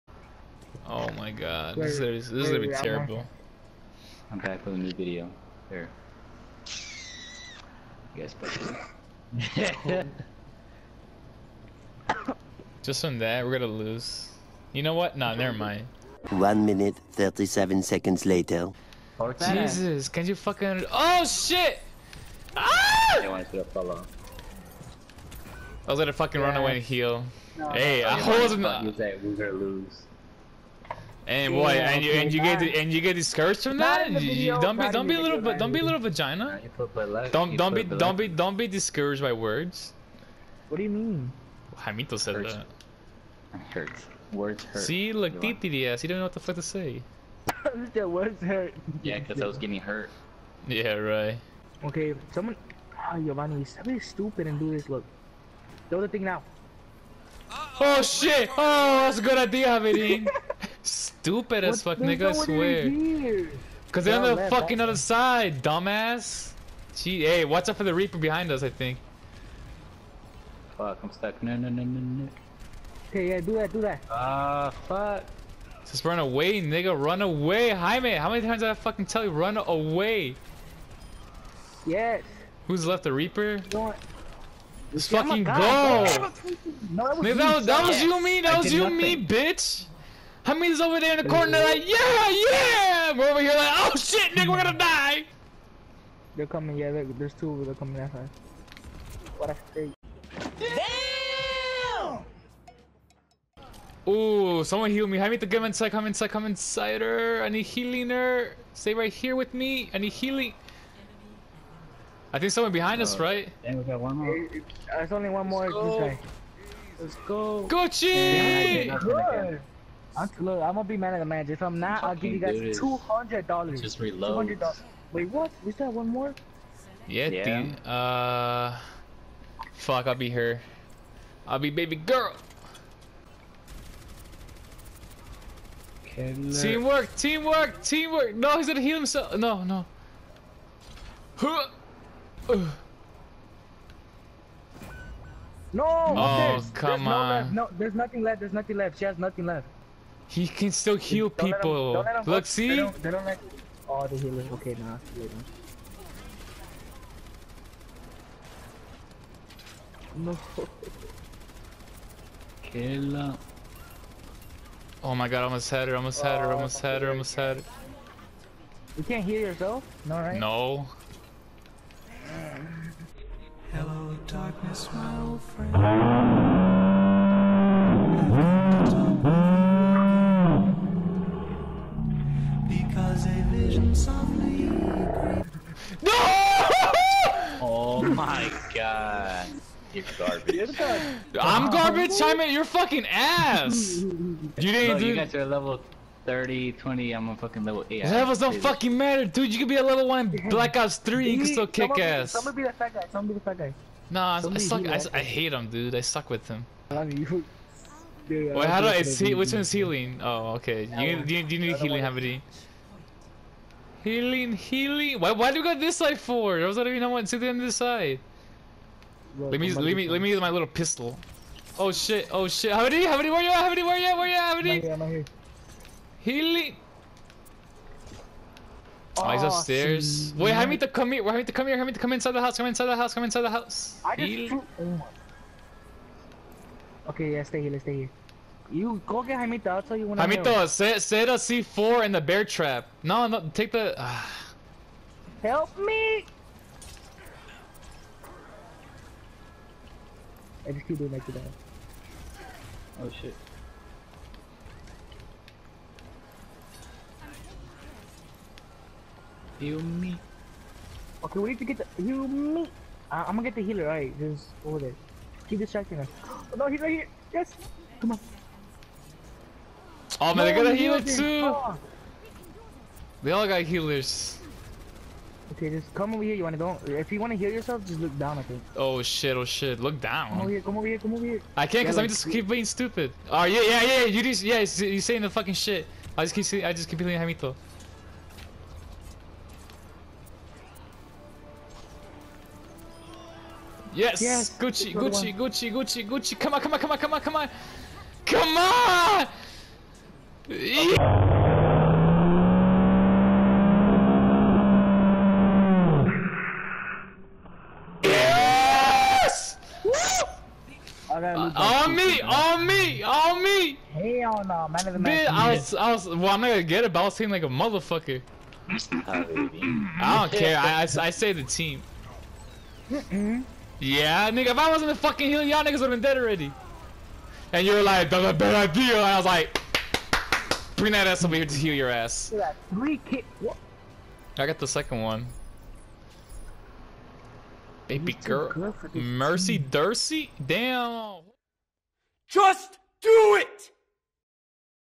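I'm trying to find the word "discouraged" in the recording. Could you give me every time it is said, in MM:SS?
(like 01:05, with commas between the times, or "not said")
00:33, 00:38.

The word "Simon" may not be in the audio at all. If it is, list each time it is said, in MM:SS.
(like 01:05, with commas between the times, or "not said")
03:12.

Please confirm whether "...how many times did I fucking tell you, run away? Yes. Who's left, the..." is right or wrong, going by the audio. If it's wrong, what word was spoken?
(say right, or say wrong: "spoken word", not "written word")
right.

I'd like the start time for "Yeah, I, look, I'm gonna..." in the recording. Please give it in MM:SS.
01:58.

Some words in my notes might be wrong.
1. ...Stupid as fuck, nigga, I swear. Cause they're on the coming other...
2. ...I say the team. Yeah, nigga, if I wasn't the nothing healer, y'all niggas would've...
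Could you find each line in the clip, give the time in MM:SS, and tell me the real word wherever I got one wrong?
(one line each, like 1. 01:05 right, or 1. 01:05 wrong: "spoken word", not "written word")
1. 01:00 wrong: "fucking", not "coming"
2. 05:20 wrong: "fucking", not "nothing".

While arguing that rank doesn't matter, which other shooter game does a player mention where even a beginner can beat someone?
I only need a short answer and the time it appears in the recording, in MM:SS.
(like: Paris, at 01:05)
Black Ops 3, at 03:20.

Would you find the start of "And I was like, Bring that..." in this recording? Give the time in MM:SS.
05:28.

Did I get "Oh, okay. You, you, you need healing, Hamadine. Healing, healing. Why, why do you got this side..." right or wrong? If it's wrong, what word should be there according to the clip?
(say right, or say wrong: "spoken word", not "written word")
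right.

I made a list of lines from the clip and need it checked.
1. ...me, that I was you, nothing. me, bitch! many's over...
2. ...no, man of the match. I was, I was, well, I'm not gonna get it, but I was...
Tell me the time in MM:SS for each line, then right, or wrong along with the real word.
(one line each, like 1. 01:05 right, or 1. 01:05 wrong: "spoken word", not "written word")
1. 01:28 right
2. 05:14 right.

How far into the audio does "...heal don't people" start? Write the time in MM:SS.
02:30.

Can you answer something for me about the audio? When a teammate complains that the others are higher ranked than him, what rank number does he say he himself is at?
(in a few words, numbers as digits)
8.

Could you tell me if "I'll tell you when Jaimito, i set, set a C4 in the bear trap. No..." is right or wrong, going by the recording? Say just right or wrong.
right.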